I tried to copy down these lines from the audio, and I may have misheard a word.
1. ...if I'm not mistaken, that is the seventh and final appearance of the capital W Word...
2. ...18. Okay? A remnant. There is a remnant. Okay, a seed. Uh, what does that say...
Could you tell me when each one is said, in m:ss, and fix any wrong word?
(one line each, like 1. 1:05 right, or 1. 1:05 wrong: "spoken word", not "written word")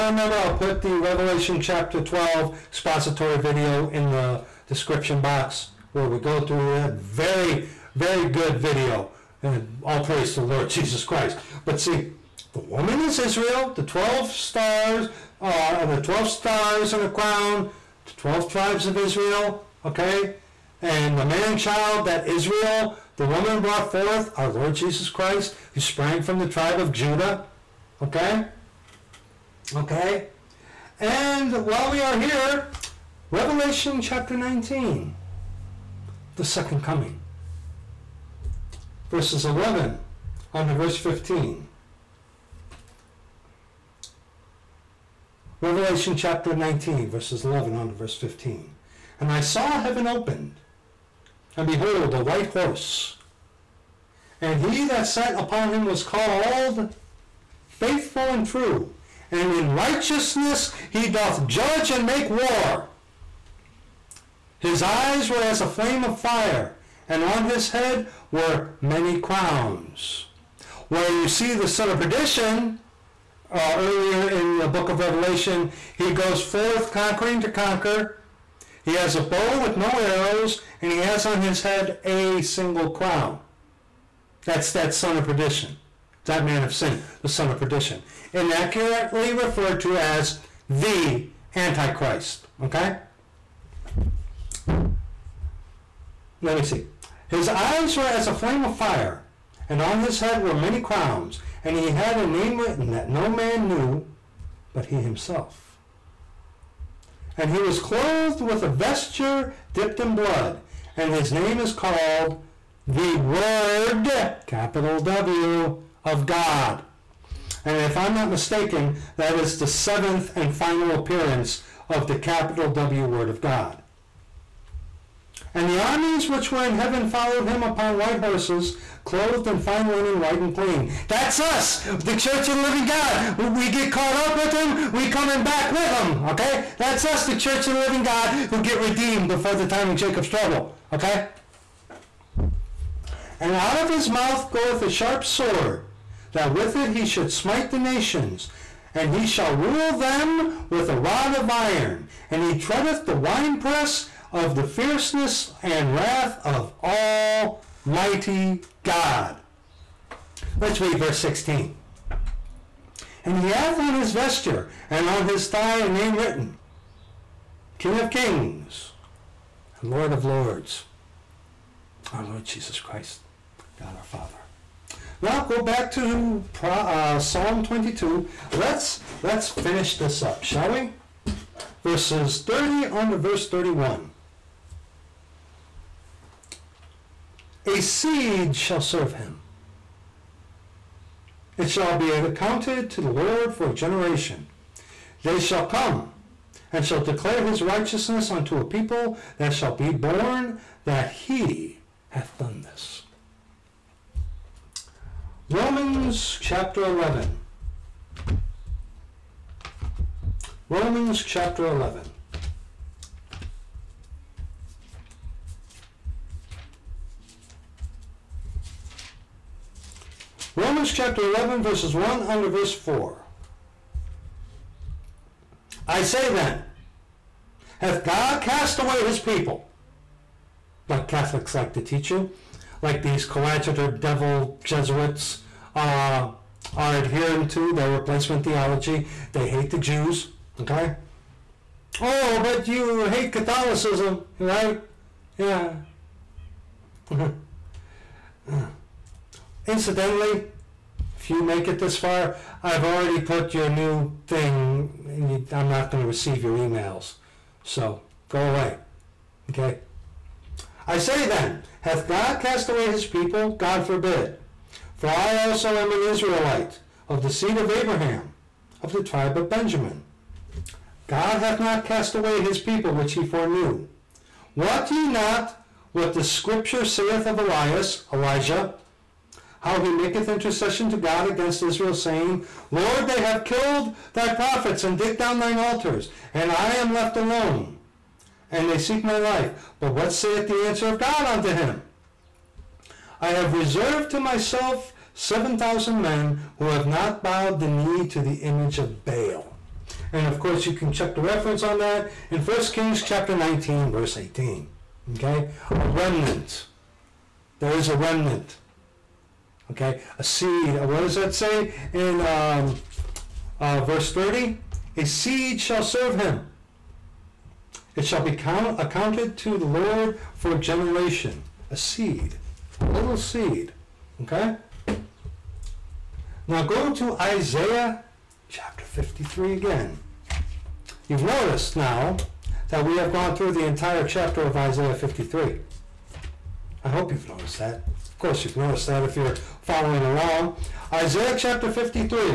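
1. 1:57 right
2. 5:04 right.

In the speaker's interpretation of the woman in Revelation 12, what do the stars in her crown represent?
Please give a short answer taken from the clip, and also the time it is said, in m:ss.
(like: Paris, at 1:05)
12 tribes of Israel, at 0:18.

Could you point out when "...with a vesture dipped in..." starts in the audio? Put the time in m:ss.
1:48.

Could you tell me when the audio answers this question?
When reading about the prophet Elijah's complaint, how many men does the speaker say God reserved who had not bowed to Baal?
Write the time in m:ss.
4:55.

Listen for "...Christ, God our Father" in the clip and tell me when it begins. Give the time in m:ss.
2:52.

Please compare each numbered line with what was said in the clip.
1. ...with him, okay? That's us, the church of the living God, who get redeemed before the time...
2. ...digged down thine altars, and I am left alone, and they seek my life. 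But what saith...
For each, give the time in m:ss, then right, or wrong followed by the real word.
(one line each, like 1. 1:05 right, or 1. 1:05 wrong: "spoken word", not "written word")
1. 2:15 right
2. 4:44 right.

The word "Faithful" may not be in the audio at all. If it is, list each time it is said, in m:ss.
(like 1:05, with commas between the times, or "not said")
0:57.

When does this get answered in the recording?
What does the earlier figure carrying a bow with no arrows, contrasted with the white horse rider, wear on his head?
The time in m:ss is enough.
1:22.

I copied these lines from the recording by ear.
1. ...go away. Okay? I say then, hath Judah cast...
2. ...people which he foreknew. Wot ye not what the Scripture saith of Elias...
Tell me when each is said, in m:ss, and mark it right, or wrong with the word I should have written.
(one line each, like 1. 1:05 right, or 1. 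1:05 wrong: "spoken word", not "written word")
1. 4:18 wrong: "God", not "Judah"
2. 4:32 right.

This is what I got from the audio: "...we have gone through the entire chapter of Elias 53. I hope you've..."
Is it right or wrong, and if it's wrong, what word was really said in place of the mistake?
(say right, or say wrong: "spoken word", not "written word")
wrong: "Isaiah", not "Elias".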